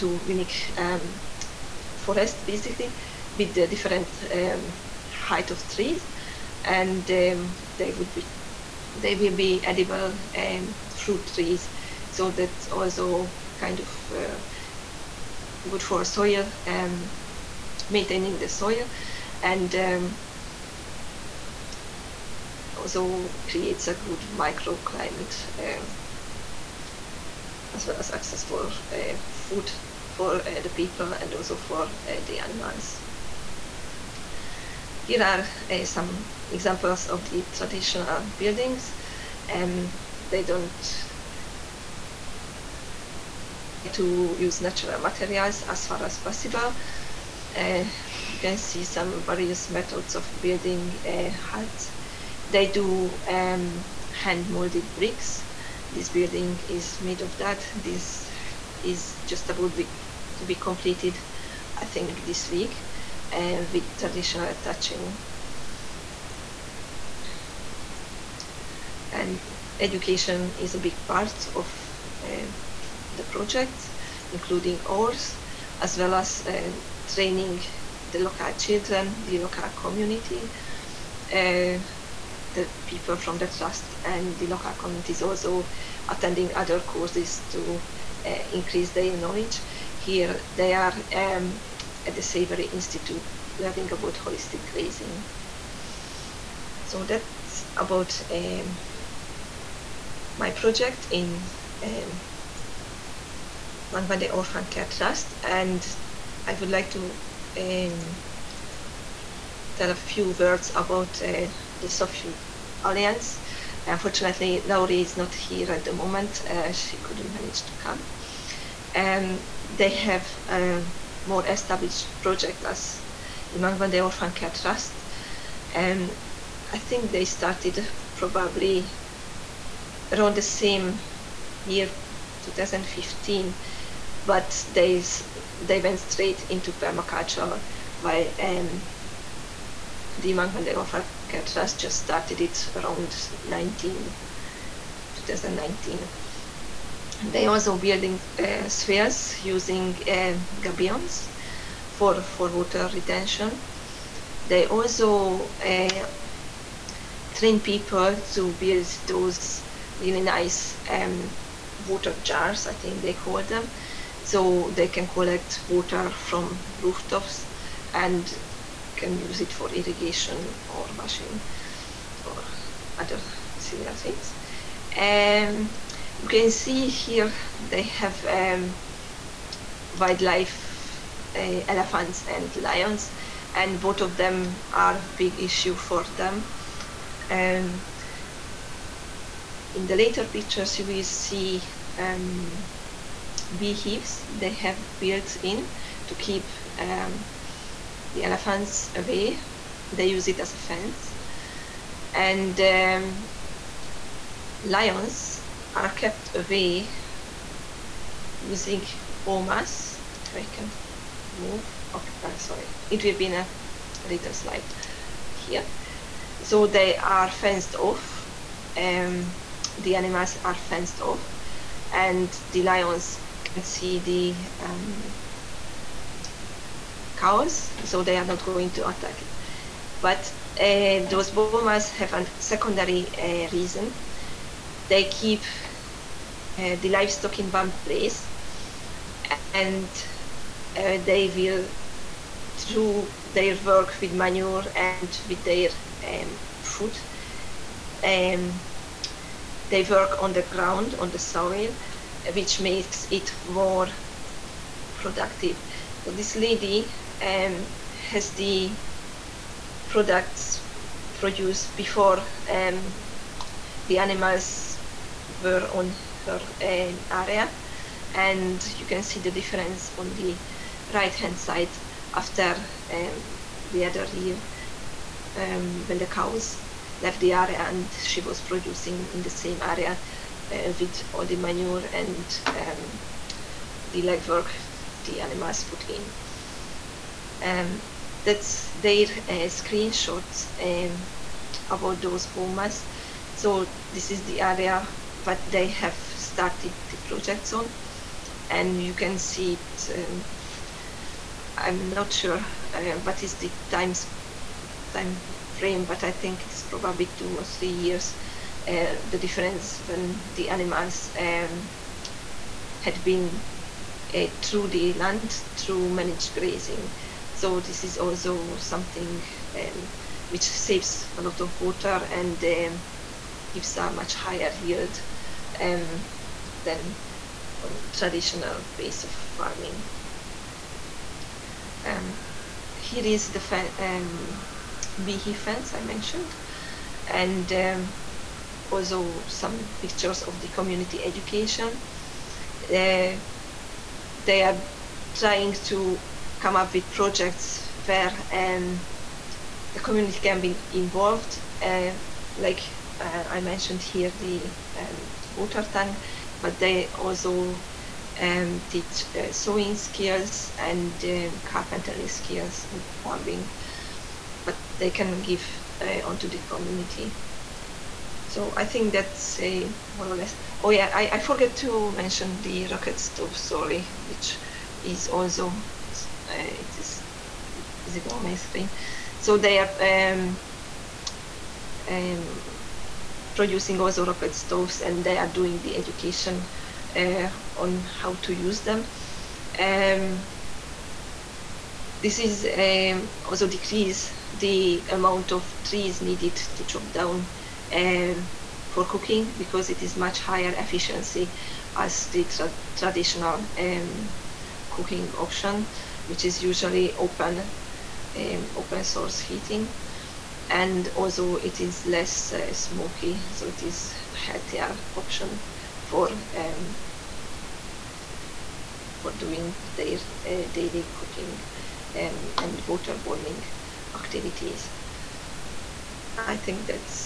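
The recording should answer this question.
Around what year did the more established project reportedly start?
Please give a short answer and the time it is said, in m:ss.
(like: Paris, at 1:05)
2015, at 2:12.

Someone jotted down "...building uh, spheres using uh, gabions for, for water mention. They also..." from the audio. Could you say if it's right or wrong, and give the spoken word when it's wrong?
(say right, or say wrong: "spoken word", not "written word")
wrong: "retention", not "mention".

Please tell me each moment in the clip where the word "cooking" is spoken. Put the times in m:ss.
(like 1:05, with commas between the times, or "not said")
6:38, 6:44, 7:00.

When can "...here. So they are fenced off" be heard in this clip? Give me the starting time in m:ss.
3:35.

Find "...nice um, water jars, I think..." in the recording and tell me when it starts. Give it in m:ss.
2:40.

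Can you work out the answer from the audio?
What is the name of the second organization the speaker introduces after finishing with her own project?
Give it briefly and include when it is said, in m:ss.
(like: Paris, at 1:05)
Soft Foot Alliance, at 1:51.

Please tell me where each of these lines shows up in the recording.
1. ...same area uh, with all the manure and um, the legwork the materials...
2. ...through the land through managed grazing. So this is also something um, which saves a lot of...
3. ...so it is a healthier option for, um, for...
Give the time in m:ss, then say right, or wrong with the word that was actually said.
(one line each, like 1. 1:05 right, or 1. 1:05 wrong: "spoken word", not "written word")
1. 4:39 wrong: "animals", not "materials"
2. 5:14 right
3. 6:53 right.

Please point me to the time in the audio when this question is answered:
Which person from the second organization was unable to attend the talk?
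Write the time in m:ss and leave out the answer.
1:54.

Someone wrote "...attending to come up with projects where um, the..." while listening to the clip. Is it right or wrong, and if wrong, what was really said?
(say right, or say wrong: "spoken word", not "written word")
wrong: "trying", not "attending".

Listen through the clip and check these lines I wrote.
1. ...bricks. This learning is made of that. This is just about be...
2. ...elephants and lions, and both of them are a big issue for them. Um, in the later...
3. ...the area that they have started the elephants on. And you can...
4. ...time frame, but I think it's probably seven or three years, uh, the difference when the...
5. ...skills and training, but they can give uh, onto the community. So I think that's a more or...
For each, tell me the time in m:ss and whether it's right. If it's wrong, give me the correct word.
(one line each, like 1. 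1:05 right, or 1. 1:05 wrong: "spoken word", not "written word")
1. 0:54 wrong: "building", not "learning"
2. 3:01 right
3. 4:54 wrong: "projects", not "elephants"
4. 5:04 wrong: "two", not "seven"
5. 6:02 wrong: "plumbing", not "training".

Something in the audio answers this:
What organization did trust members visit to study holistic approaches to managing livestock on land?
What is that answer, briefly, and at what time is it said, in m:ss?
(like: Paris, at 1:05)
Savory Institute, at 1:32.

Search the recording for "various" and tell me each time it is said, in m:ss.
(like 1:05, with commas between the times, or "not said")
0:49.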